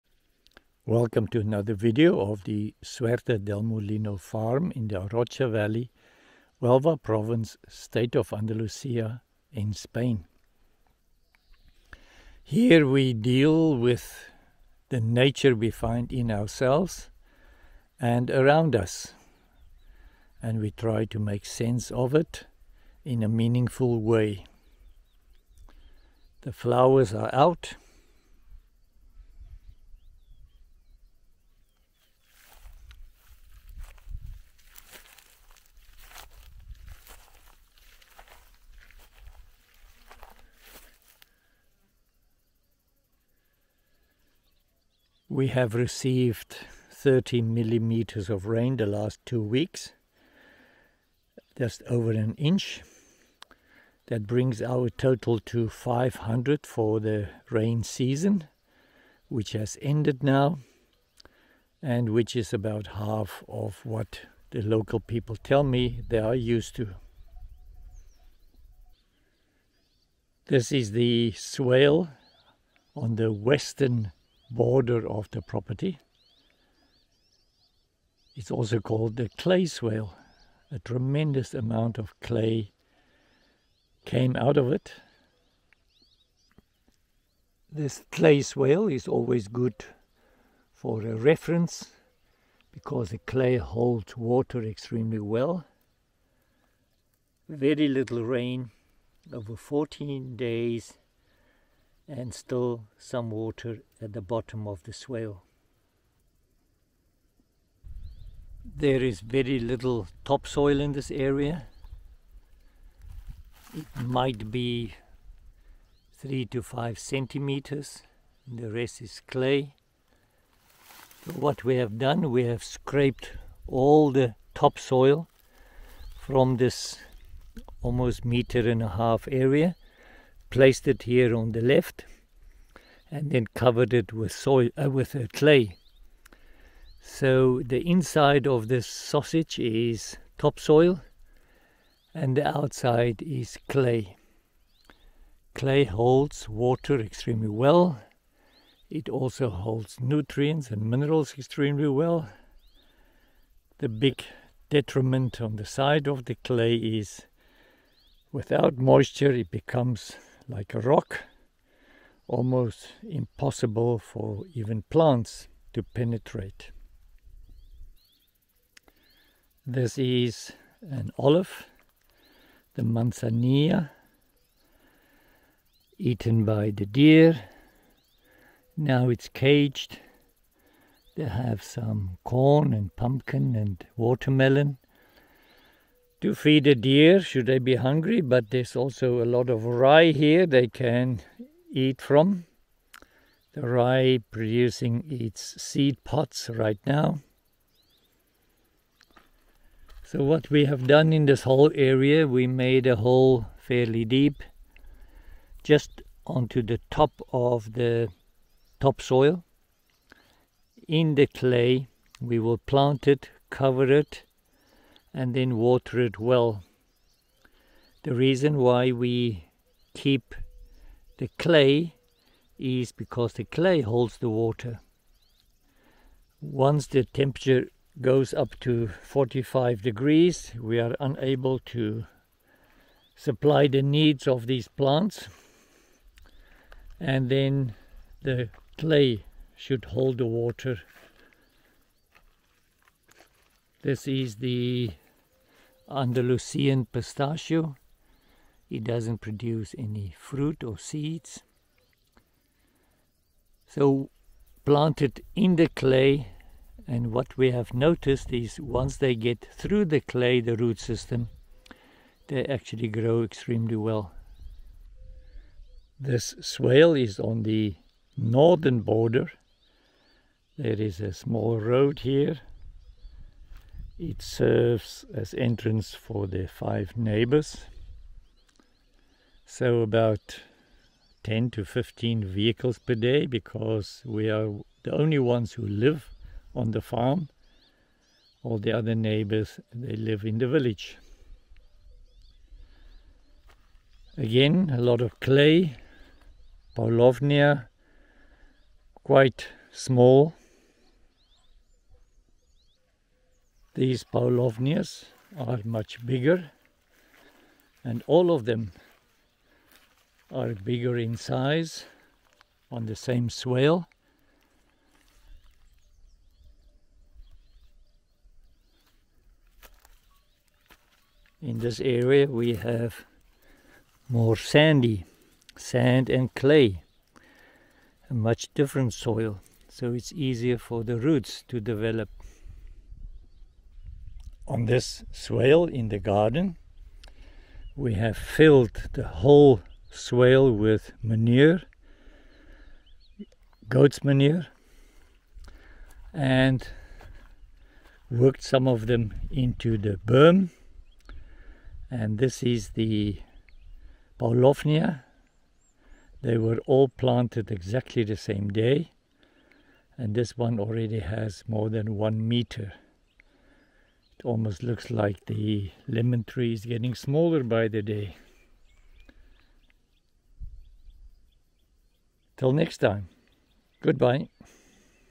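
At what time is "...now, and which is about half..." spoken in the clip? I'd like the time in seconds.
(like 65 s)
60 s.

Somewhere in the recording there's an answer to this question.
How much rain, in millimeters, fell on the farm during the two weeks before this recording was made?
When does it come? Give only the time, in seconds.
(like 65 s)
46 s.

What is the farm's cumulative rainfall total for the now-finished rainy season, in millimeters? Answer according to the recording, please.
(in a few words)
500.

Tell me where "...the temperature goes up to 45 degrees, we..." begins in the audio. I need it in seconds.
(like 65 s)
226 s.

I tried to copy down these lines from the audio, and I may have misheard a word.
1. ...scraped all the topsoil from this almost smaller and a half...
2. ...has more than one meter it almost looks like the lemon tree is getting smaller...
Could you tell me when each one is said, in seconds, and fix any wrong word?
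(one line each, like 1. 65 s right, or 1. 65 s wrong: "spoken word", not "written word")
1. 122 s wrong: "meter", not "smaller"
2. 360 s right.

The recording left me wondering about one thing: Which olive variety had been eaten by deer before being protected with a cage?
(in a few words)
Manzanilla.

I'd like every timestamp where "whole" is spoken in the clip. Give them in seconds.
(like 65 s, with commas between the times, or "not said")
201 s, 339 s.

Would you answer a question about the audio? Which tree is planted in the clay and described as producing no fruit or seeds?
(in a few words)
Andalusian pistachio.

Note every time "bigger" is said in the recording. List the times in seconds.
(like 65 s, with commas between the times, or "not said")
306 s, 310 s.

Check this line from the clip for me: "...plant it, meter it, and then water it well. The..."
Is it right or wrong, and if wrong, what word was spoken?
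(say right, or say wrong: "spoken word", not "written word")
wrong: "cover", not "meter".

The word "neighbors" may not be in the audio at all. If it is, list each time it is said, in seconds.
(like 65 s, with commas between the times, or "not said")
276 s, 288 s.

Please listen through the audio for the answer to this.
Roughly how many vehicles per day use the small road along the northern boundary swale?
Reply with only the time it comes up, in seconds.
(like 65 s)
281 s.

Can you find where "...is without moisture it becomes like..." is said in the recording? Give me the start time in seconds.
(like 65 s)
156 s.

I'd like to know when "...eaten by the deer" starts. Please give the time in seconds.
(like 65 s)
175 s.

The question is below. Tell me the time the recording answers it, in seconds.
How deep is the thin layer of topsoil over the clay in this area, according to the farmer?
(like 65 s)
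116 s.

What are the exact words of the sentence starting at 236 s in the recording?
And then the clay should hold the water.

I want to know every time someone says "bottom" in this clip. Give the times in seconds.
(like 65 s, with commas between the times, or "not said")
104 s.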